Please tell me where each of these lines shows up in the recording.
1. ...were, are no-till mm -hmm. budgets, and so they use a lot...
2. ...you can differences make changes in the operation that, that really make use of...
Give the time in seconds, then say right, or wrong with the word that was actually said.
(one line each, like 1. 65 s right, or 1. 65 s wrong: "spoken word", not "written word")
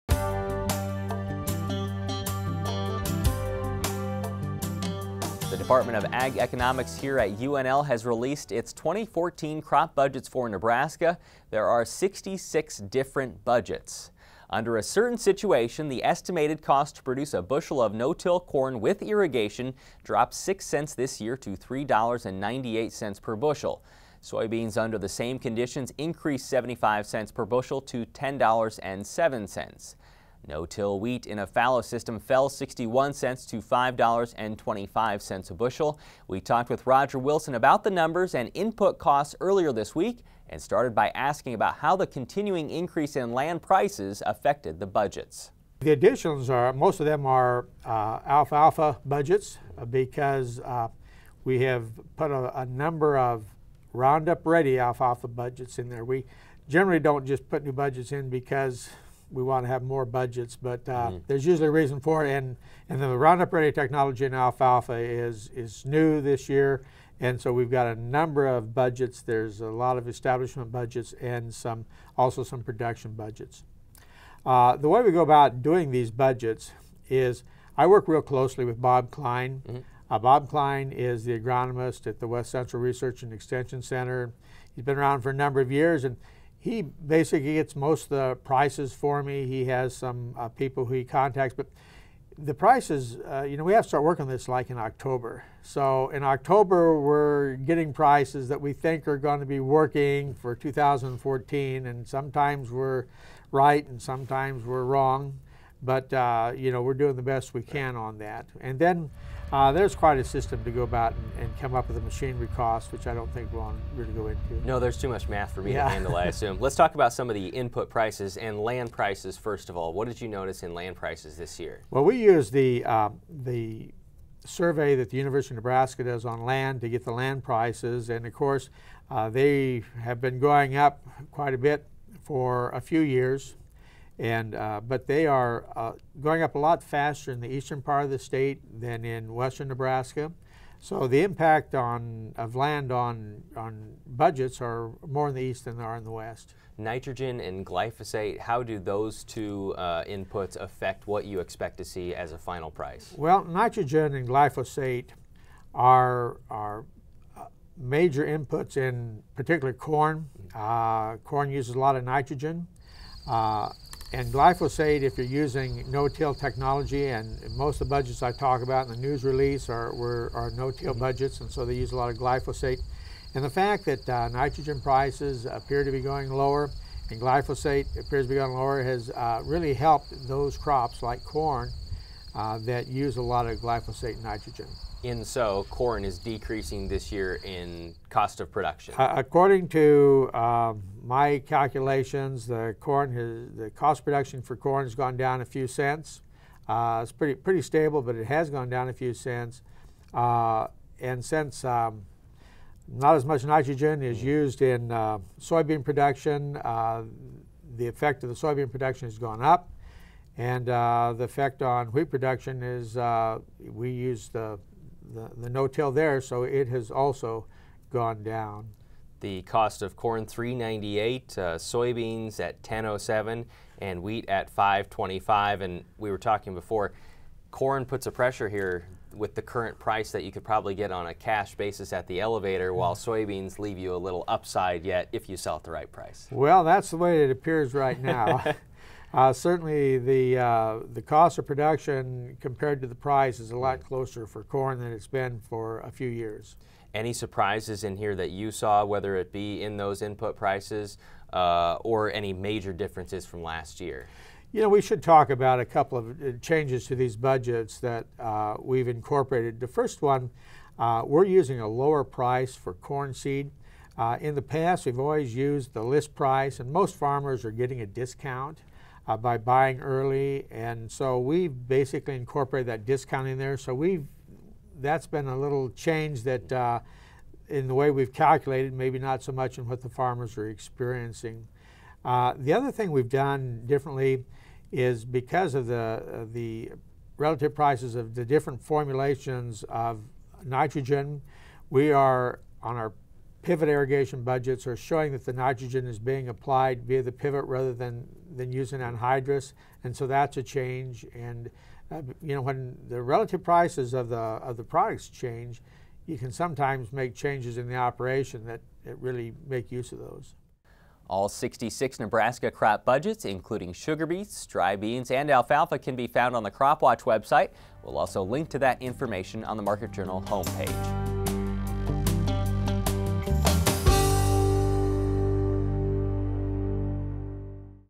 1. 169 s right
2. 306 s wrong: "sometimes", not "differences".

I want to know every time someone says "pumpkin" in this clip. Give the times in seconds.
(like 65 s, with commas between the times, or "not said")
not said.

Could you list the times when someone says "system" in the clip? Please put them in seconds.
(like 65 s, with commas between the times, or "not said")
31 s, 110 s.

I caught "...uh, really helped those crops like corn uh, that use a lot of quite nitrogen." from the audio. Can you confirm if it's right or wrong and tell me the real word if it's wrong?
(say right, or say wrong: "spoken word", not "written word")
wrong: "glyphosate", not "quite".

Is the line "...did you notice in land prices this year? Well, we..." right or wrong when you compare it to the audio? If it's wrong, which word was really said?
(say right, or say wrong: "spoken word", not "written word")
right.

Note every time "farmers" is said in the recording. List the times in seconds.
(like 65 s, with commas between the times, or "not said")
266 s, 279 s.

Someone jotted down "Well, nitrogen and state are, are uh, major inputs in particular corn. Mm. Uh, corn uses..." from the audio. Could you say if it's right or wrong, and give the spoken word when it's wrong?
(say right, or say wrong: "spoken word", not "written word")
wrong: "glyphosate", not "state".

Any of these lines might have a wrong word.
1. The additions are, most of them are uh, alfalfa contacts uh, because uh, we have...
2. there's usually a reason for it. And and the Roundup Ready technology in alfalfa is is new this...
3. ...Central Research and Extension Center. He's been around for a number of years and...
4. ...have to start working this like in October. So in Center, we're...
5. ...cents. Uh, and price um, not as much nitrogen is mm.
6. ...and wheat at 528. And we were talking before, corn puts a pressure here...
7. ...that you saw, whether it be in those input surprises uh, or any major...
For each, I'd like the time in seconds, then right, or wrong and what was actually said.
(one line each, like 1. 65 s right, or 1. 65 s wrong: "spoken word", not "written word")
1. 45 s wrong: "budgets", not "contacts"
2. 61 s right
3. 82 s right
4. 93 s wrong: "October", not "Center"
5. 199 s wrong: "since", not "price"
6. 223 s wrong: "525", not "528"
7. 248 s wrong: "prices", not "surprises".